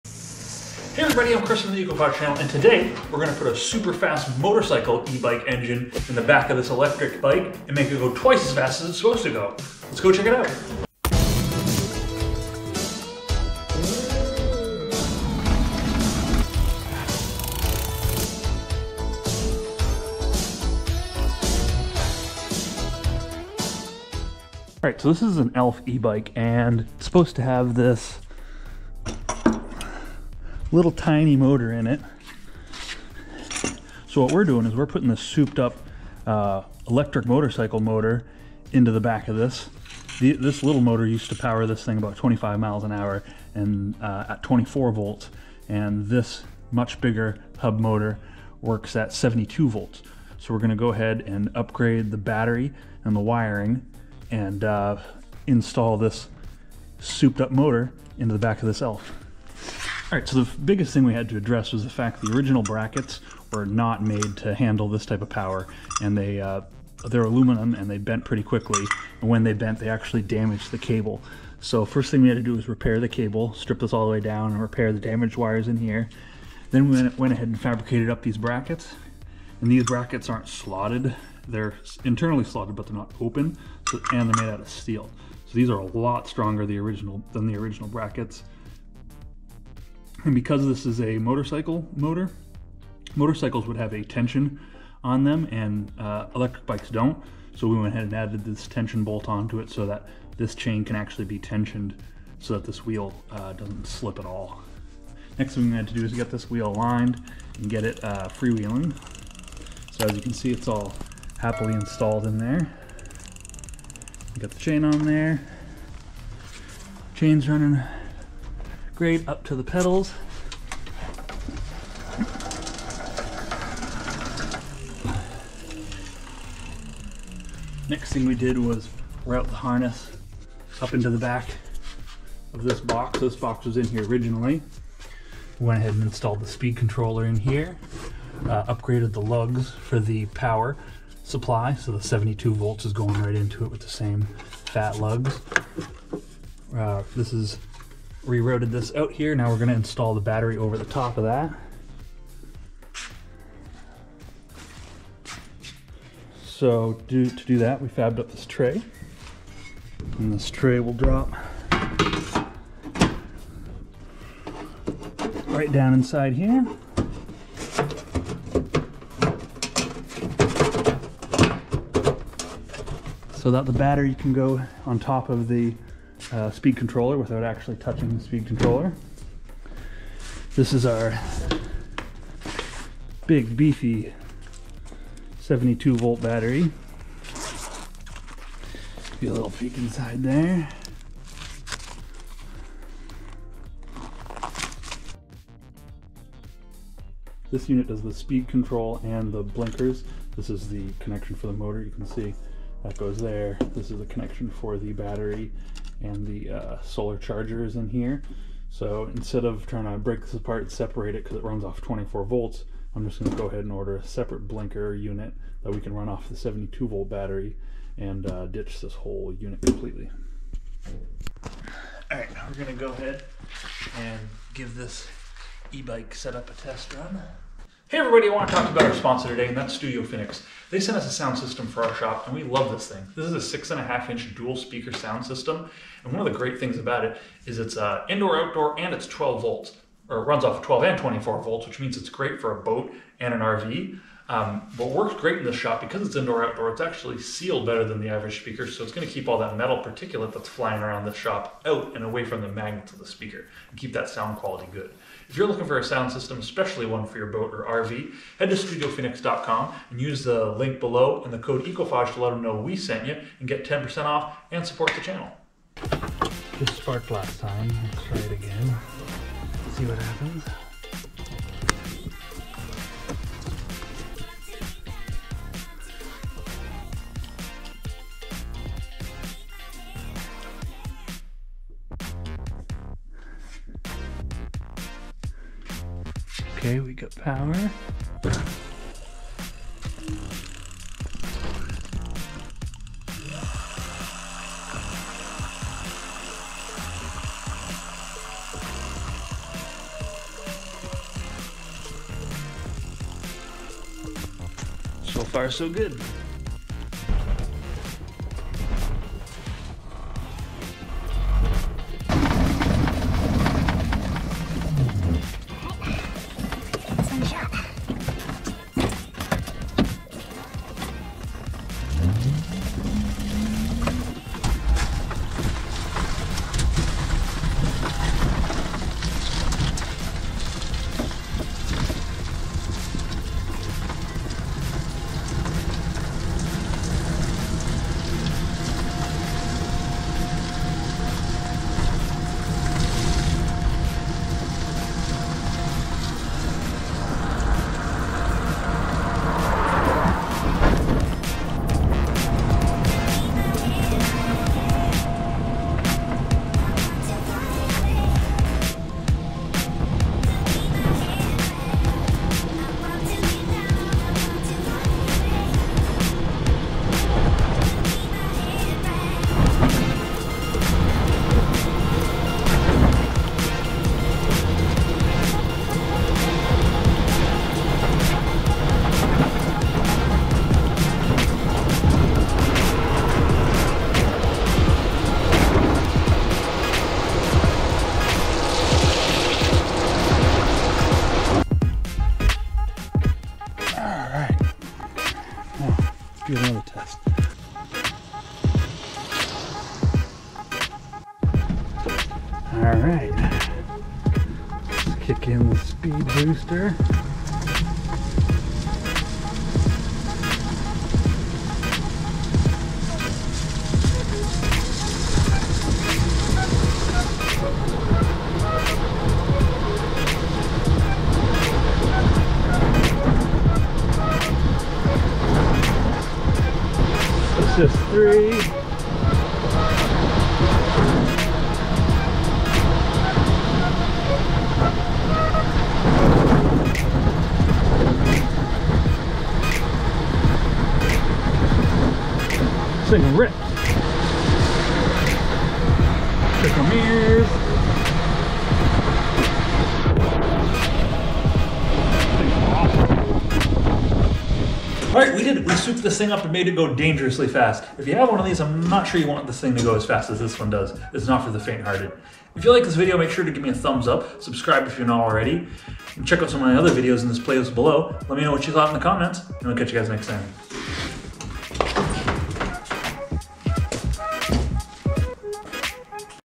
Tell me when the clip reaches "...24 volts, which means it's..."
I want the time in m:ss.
4:00.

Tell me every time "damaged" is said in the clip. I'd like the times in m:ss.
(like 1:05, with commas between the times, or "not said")
1:10, 1:14.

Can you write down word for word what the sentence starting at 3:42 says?
Alright, we're going to go ahead and give this e-bike setup a test run.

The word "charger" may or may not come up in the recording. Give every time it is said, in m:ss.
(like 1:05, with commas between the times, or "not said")
3:27.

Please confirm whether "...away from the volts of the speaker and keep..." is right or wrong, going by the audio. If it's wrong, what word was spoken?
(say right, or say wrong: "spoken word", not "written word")
wrong: "magnets", not "volts".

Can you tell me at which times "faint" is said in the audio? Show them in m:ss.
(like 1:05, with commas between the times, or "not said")
7:41.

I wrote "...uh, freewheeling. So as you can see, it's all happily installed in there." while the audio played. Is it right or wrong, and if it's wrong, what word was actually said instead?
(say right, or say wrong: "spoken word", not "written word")
right.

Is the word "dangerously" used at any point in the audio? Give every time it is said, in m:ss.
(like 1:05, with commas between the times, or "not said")
7:36.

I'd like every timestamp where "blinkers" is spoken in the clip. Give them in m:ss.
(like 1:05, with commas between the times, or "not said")
3:19, 3:34.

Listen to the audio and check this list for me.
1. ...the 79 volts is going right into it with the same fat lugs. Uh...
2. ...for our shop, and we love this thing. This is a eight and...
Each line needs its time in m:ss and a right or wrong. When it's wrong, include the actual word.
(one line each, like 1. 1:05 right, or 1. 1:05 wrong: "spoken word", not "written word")
1. 2:21 wrong: "72", not "79"
2. 3:51 wrong: "six", not "eight".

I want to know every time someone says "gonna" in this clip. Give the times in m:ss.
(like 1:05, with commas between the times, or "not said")
0:03, 0:50, 2:29.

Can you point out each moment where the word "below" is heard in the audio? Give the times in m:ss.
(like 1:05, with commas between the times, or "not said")
4:20, 7:47.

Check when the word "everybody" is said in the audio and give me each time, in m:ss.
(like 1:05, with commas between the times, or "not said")
0:01, 3:47.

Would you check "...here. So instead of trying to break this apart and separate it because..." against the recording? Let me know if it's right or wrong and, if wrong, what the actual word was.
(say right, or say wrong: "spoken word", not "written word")
right.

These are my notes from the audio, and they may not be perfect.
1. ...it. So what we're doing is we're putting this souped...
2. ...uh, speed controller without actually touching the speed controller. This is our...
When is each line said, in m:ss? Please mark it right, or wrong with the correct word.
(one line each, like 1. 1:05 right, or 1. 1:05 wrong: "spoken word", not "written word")
1. 0:31 right
2. 2:56 right.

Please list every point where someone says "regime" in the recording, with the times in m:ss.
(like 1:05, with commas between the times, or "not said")
not said.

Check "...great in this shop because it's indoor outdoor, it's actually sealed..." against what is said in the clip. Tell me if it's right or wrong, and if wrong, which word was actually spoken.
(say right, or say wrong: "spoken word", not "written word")
right.